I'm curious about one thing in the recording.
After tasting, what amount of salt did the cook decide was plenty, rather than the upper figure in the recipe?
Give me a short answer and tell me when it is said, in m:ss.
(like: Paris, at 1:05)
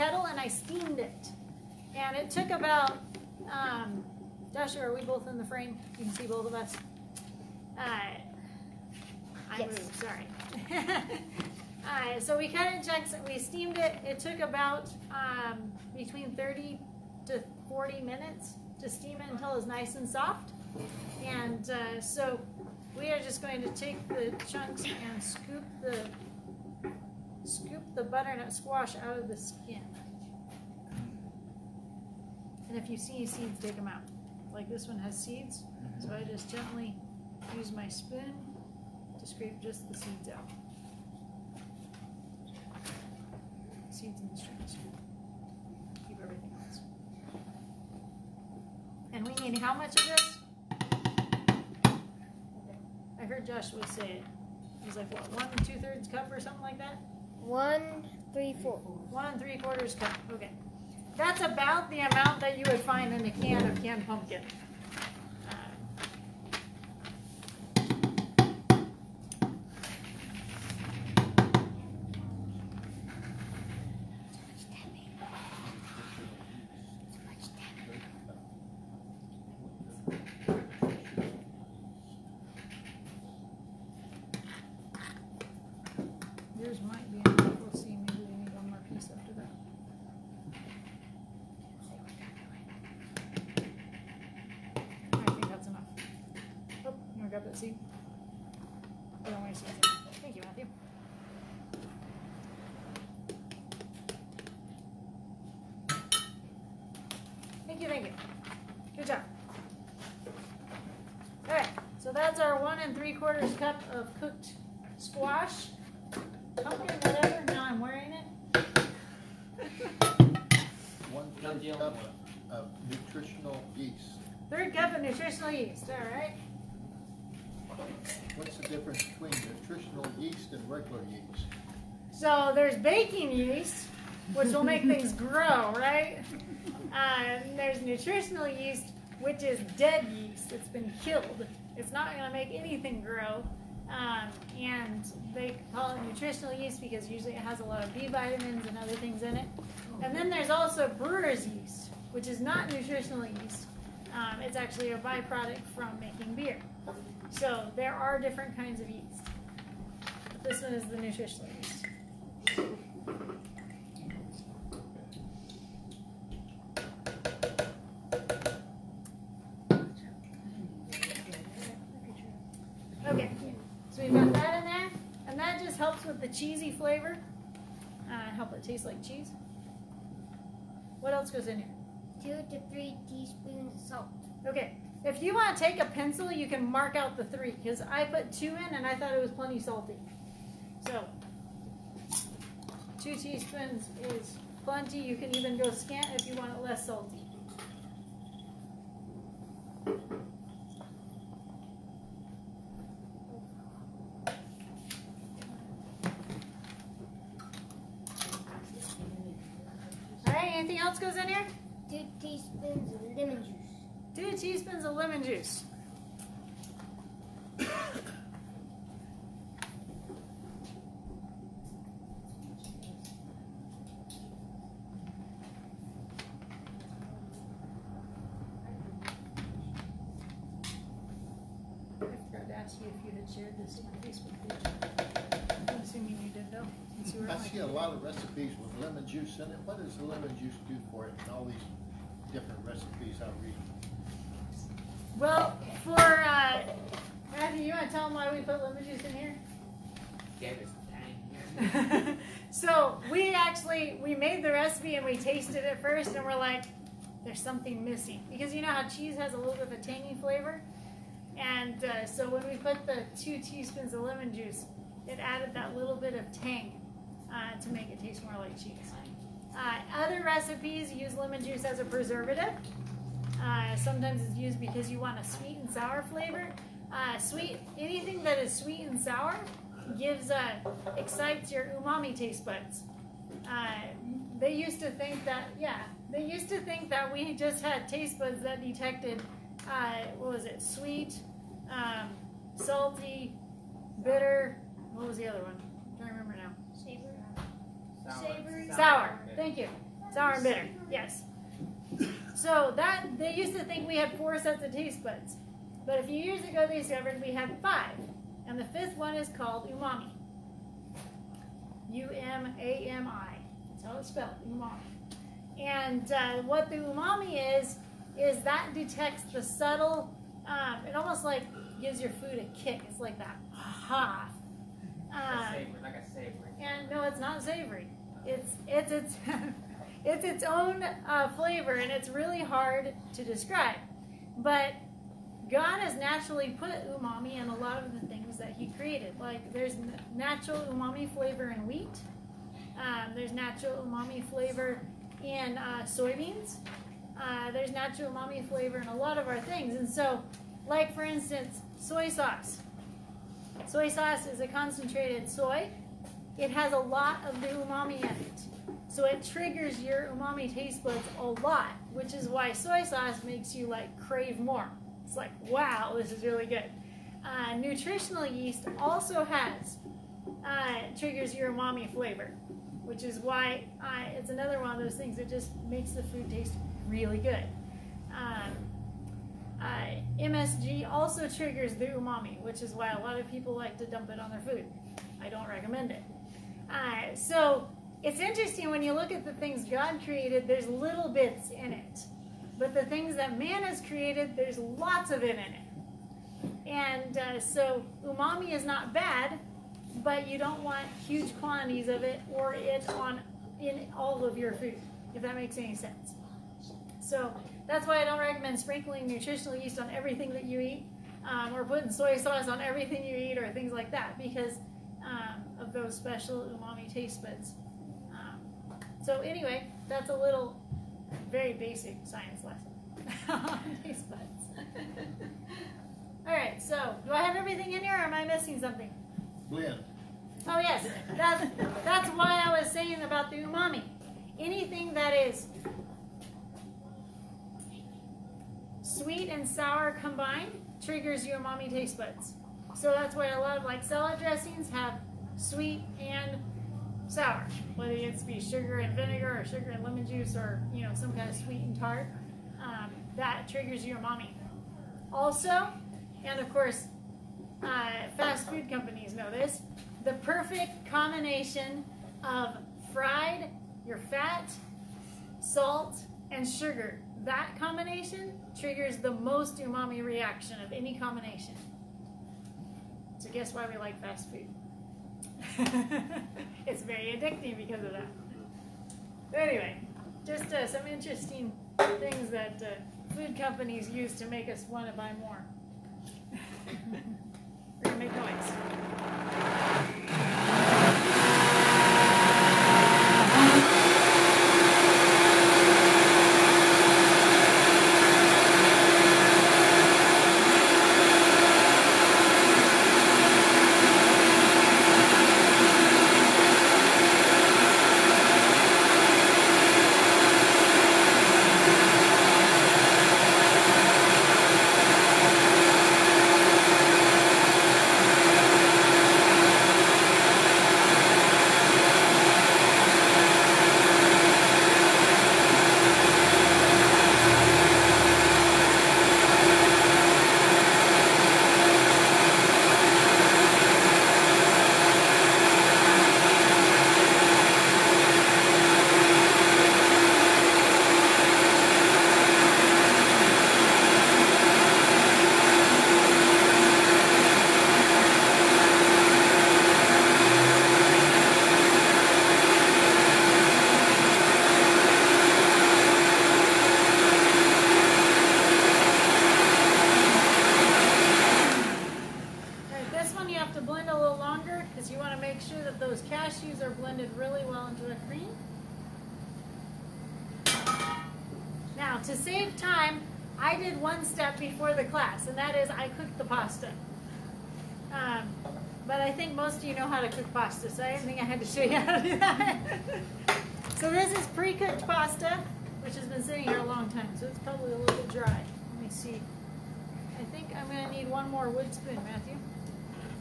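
2 teaspoons, at 3:13.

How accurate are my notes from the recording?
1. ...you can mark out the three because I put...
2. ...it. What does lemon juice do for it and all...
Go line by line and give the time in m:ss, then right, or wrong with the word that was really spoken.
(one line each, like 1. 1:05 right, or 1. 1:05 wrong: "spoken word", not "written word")
1. 3:06 right
2. 3:59 right.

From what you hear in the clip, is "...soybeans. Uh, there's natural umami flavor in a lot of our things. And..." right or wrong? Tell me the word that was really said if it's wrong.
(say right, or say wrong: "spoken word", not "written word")
right.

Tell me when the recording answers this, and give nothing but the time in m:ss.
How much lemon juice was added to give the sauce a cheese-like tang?
4:23.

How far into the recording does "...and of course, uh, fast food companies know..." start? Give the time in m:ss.
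7:36.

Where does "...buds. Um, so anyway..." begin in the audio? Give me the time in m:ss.
6:57.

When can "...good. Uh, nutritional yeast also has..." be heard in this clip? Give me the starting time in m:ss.
6:06.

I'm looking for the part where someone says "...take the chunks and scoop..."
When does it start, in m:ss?
0:23.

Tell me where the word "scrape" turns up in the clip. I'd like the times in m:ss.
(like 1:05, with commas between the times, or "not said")
0:39.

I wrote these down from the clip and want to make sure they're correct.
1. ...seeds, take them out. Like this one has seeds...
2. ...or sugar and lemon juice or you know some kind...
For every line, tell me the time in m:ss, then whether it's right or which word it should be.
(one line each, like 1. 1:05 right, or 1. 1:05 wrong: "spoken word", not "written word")
1. 0:33 right
2. 7:29 right.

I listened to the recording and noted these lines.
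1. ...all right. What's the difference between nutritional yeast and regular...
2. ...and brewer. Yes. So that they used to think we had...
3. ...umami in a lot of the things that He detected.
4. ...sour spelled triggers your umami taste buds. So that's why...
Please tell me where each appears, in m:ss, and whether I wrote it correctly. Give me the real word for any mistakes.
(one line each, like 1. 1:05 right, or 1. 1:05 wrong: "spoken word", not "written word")
1. 2:05 right
2. 5:00 wrong: "bitter", not "brewer"
3. 5:36 wrong: "created", not "detected"
4. 7:19 wrong: "combined", not "spelled".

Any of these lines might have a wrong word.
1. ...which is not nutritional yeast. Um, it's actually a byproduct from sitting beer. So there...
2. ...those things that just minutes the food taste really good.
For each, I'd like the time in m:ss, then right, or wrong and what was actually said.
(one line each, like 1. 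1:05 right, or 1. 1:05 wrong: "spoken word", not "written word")
1. 2:32 wrong: "making", not "sitting"
2. 6:14 wrong: "makes", not "minutes".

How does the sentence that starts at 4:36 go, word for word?
Uh, sweet, anything that is sweet and sour gives, uh, excites your umami taste buds.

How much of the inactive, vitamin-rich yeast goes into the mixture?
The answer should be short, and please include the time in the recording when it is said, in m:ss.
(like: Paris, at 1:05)
1/3 cup, at 2:01.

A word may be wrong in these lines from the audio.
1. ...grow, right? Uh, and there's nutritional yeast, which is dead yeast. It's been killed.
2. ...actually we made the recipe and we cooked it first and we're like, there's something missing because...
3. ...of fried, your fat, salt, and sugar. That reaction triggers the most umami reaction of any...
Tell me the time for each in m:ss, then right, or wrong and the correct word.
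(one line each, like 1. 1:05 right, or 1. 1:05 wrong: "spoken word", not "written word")
1. 2:15 right
2. 4:13 wrong: "tasted", not "cooked"
3. 7:42 wrong: "combination", not "reaction".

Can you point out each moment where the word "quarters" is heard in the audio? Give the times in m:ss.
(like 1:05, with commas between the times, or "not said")
0:59, 1:53.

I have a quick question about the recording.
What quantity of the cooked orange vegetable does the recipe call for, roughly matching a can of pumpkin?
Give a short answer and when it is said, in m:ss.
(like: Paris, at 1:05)
1 3/4 cup, at 0:59.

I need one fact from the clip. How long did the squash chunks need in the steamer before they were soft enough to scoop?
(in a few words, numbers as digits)
30 to 40 minutes.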